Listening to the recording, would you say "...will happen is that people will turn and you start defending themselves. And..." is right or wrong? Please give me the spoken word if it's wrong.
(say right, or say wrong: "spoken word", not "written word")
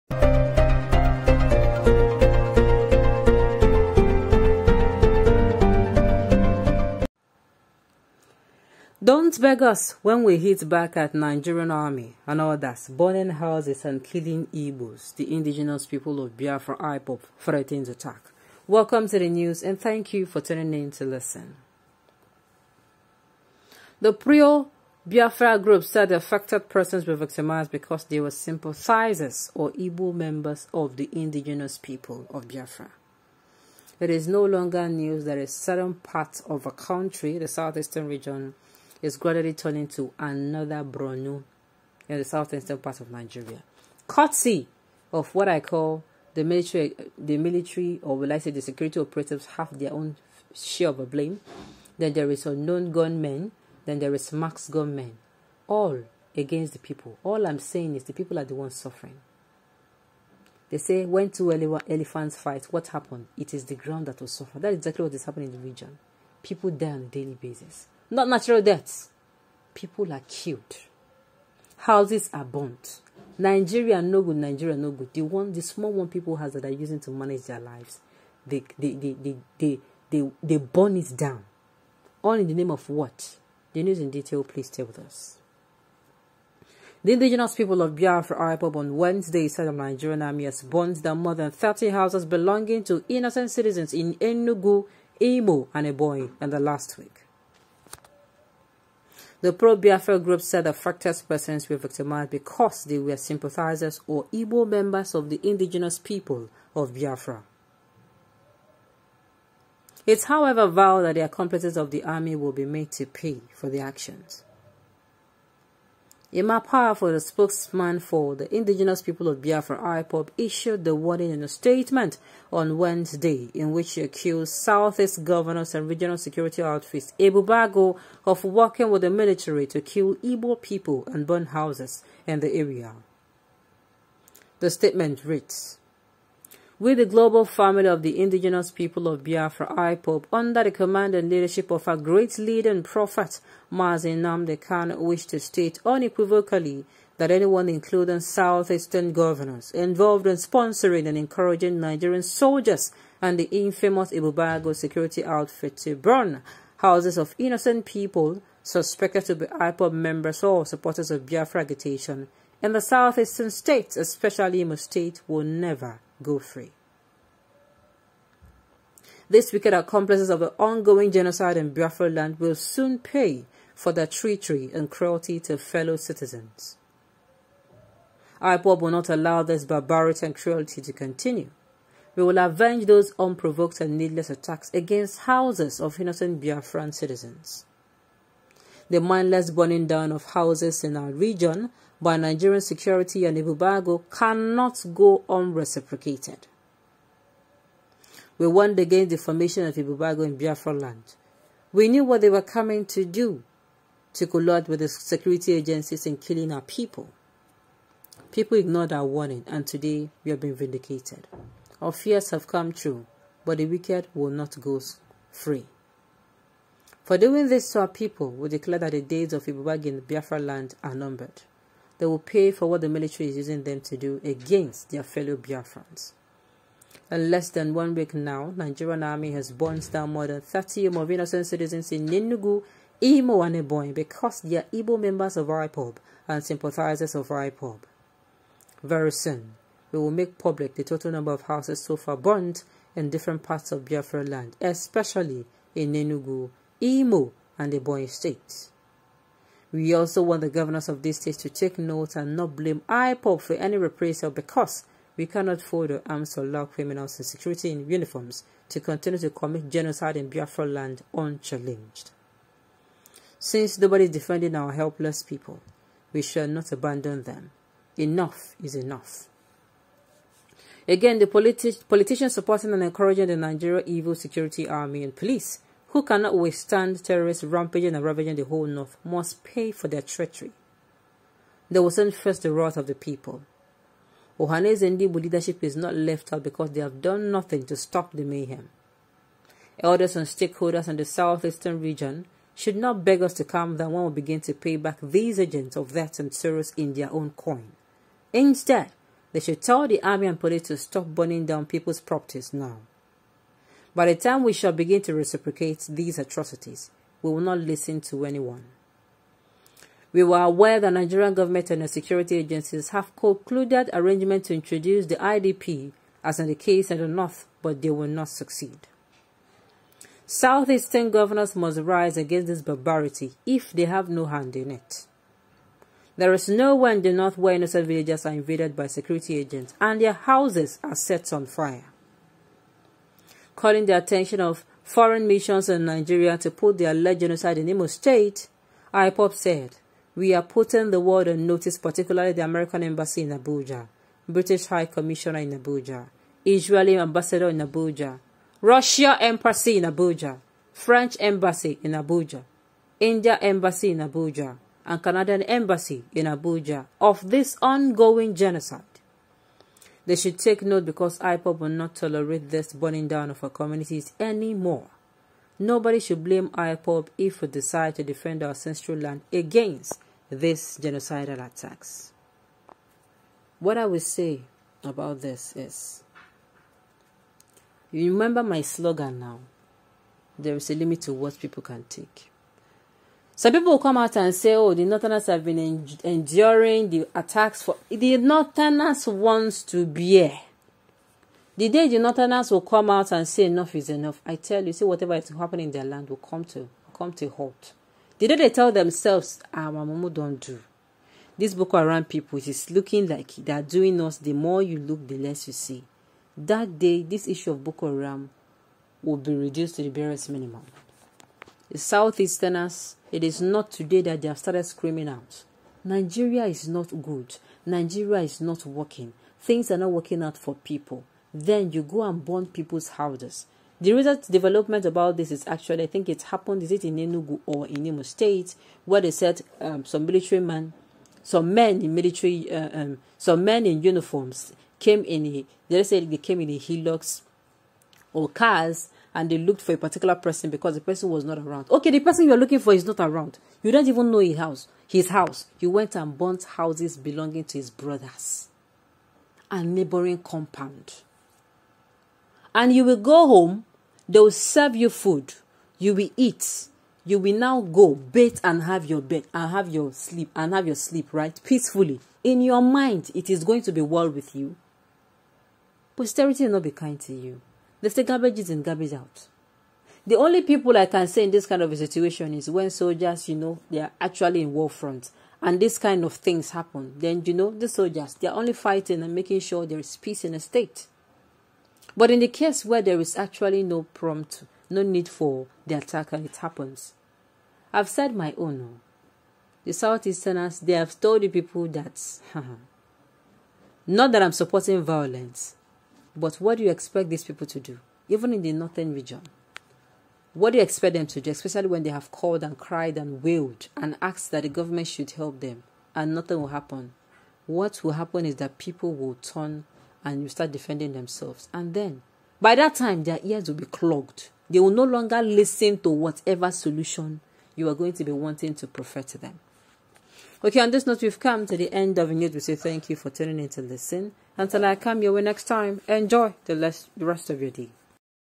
right.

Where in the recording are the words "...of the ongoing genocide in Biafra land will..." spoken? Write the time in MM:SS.
02:50.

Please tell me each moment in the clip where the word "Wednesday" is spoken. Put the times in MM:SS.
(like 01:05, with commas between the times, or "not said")
01:28, 02:02.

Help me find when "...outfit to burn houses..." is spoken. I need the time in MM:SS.
02:35.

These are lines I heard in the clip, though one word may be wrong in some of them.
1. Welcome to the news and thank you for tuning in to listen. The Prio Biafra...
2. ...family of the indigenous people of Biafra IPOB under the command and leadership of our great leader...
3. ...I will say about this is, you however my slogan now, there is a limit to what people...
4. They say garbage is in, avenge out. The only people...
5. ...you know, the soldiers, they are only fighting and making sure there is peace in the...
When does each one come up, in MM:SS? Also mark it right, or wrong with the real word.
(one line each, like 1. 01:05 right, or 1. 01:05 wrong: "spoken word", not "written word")
1. 00:18 right
2. 02:17 right
3. 06:13 wrong: "remember", not "however"
4. 07:47 wrong: "garbage", not "avenge"
5. 07:57 right.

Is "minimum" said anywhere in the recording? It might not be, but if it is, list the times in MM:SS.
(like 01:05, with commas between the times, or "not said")
06:50.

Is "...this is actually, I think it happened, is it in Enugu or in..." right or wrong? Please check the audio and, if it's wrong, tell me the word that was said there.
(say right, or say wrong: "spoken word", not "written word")
right.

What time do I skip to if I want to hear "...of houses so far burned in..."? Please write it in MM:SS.
04:01.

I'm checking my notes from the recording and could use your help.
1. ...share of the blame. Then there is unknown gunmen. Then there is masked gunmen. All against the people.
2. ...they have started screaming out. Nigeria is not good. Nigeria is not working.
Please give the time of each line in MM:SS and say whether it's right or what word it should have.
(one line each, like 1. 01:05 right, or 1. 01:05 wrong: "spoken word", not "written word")
1. 00:50 right
2. 06:54 right.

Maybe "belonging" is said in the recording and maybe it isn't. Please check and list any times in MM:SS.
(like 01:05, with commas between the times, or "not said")
01:32, 07:26.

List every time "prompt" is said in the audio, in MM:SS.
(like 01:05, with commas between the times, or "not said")
08:03.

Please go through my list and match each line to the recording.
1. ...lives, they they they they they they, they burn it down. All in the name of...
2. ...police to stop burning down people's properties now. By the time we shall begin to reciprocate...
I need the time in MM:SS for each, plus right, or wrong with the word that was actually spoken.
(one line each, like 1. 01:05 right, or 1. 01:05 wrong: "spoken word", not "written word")
1. 01:17 right
2. 05:00 right.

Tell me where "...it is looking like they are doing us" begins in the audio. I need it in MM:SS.
06:42.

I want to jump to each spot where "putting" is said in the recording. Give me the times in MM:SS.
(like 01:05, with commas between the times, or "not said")
05:40.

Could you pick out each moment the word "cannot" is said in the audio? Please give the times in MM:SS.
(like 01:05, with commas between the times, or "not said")
03:14, 04:15, 04:36.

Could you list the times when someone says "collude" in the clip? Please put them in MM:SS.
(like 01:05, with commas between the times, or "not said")
03:24.